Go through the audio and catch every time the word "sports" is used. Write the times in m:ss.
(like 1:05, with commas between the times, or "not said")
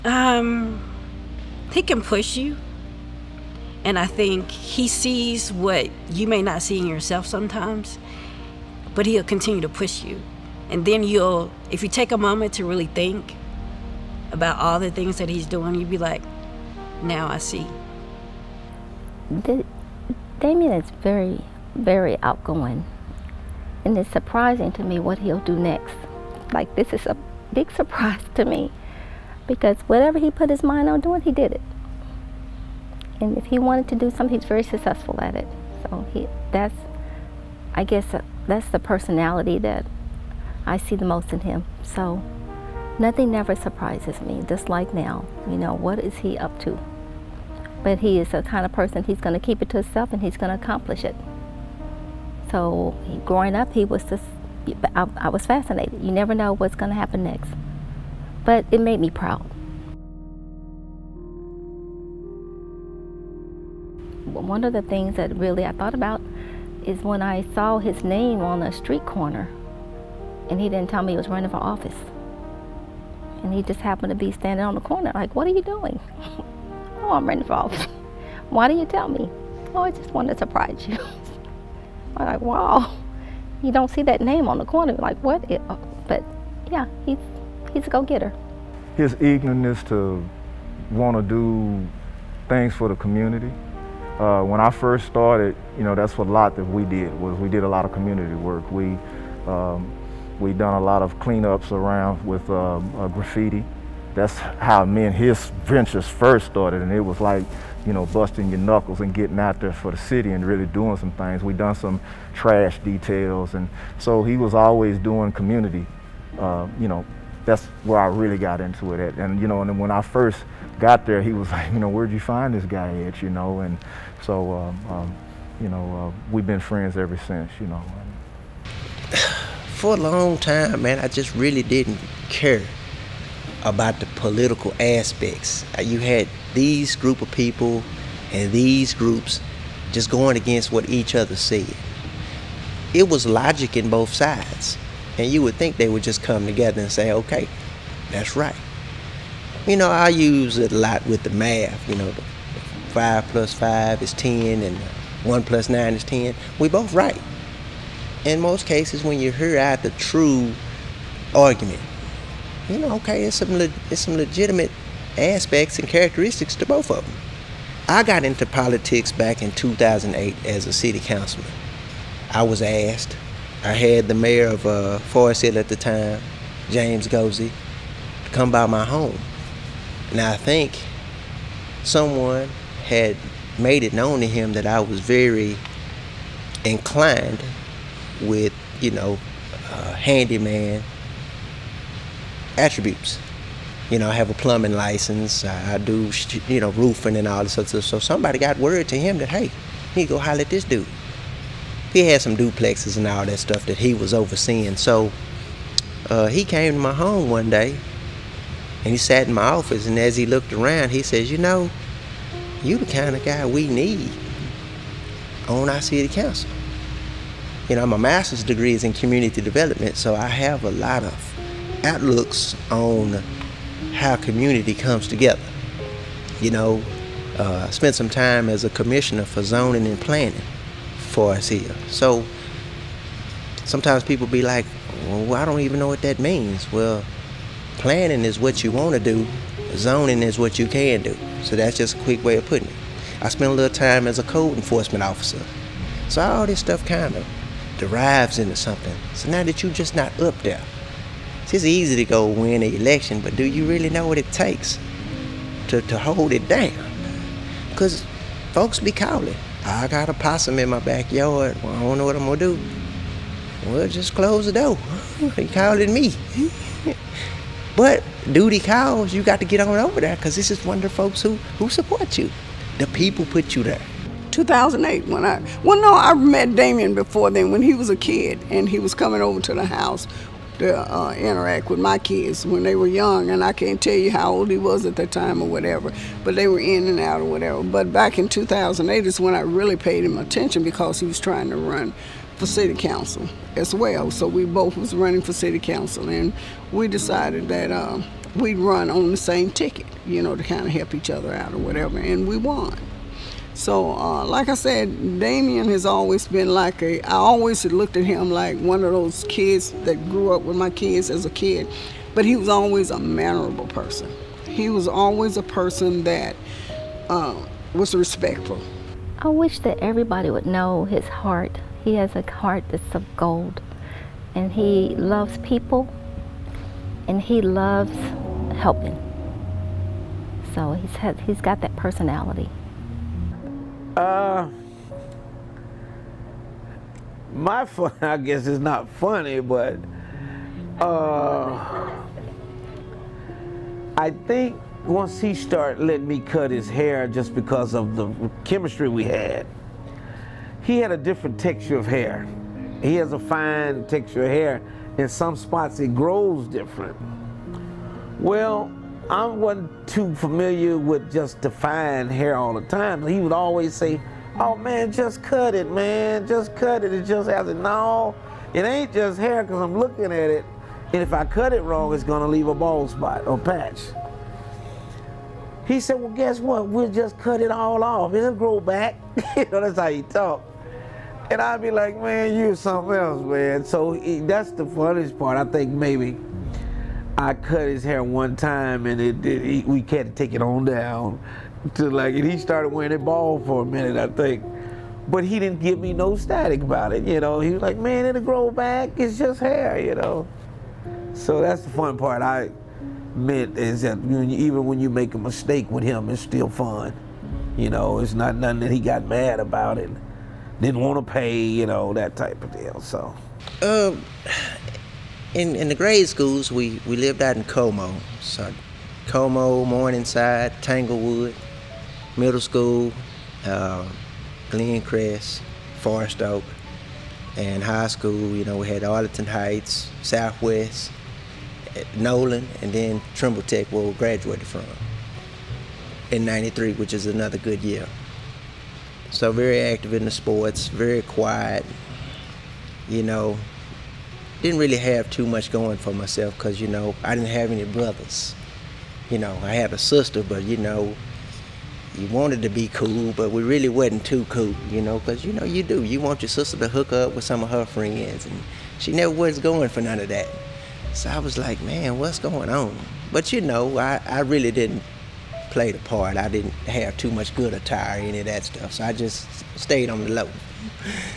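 7:20.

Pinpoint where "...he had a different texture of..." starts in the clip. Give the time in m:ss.
5:50.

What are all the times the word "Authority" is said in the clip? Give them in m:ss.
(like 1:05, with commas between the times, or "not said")
not said.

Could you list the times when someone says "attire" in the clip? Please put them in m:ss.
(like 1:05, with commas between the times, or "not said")
7:47.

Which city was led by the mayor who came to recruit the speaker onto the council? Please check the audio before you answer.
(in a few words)
Forest Hill.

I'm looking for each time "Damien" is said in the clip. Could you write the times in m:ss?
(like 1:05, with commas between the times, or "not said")
0:20, 4:36, 5:05.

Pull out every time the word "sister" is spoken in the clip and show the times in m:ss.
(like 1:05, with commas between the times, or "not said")
7:29, 7:36.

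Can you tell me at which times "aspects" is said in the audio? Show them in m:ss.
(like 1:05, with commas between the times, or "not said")
2:14, 2:45.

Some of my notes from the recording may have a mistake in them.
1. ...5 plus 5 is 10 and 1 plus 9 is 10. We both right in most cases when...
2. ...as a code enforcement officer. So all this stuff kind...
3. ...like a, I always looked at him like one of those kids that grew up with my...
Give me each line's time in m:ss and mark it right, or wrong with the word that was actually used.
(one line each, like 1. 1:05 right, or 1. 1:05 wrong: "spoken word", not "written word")
1. 2:32 right
2. 4:04 right
3. 5:06 right.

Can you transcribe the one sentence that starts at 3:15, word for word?
I do you know roofing and all this stuff.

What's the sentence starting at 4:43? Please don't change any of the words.
And I can't tell you how old he was at that time or whatever, but they were in and out or whatever.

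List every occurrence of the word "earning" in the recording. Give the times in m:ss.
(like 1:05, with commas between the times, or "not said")
not said.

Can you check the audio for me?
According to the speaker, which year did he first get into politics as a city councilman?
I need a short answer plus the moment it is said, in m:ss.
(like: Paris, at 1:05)
2008, at 2:49.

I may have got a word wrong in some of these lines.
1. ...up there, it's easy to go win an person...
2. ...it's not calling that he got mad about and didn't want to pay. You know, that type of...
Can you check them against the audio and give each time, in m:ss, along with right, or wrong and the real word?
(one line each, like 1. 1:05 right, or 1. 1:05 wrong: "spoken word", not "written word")
1. 4:10 wrong: "election", not "person"
2. 6:47 wrong: "nothing", not "calling".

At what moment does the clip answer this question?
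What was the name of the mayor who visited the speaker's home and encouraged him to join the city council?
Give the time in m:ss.
2:56.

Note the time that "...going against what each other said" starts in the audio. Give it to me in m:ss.
2:20.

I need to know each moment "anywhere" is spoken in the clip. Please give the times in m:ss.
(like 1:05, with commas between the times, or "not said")
not said.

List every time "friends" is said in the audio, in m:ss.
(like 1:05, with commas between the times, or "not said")
2:06, 7:37.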